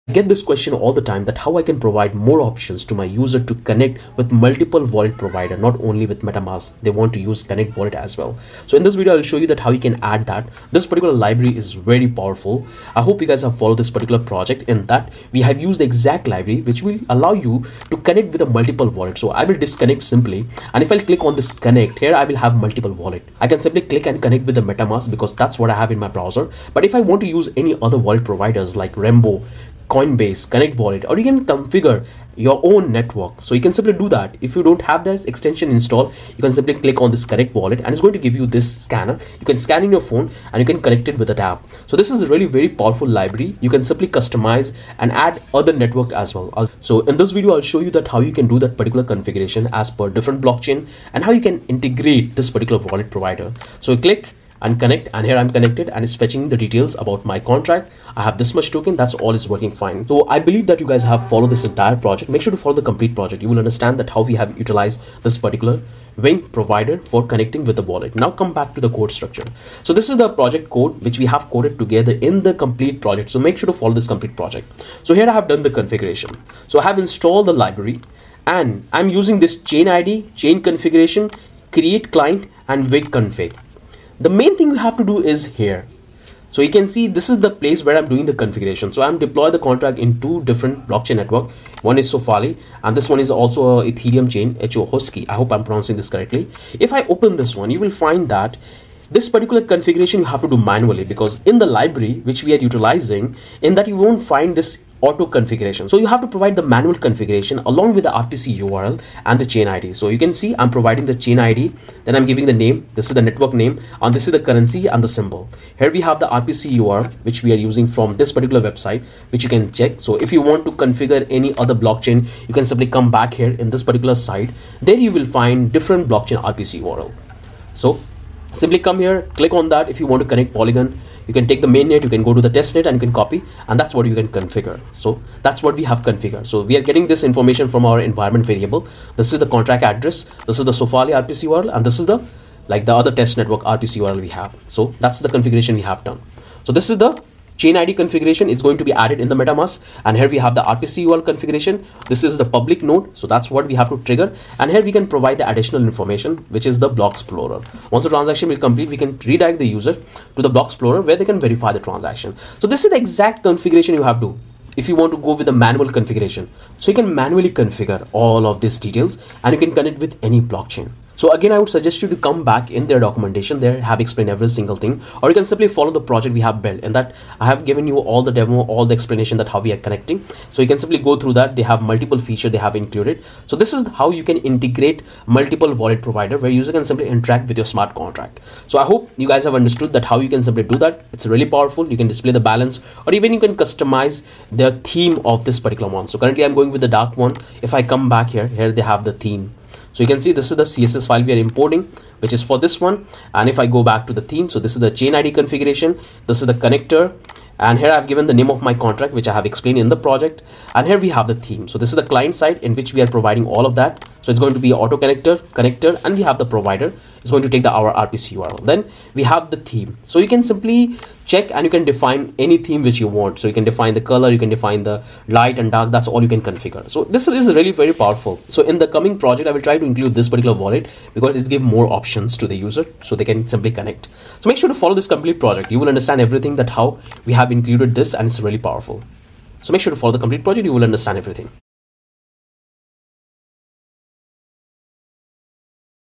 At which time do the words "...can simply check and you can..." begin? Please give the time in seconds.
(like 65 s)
220 s.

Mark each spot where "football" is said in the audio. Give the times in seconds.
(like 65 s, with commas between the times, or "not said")
not said.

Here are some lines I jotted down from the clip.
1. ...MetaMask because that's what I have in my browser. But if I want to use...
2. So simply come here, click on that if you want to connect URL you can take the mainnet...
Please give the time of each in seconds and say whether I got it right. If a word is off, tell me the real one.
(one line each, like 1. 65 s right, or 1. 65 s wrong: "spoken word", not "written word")
1. 24 s right
2. 127 s wrong: "Polygon", not "URL".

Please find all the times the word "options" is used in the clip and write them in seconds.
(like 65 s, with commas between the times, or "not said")
2 s, 231 s.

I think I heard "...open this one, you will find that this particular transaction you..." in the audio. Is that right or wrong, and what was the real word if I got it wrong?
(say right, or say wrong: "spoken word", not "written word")
wrong: "configuration", not "transaction".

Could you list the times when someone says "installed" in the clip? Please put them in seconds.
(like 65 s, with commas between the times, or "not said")
35 s, 76 s.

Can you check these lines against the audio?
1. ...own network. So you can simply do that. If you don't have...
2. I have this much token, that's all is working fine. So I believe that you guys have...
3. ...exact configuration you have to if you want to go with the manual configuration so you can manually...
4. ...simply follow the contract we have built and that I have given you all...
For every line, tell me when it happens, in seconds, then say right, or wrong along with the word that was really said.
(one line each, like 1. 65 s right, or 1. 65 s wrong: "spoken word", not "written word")
1. 32 s right
2. 58 s right
3. 163 s right
4. 175 s wrong: "project", not "contract".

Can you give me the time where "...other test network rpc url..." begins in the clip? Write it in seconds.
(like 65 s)
143 s.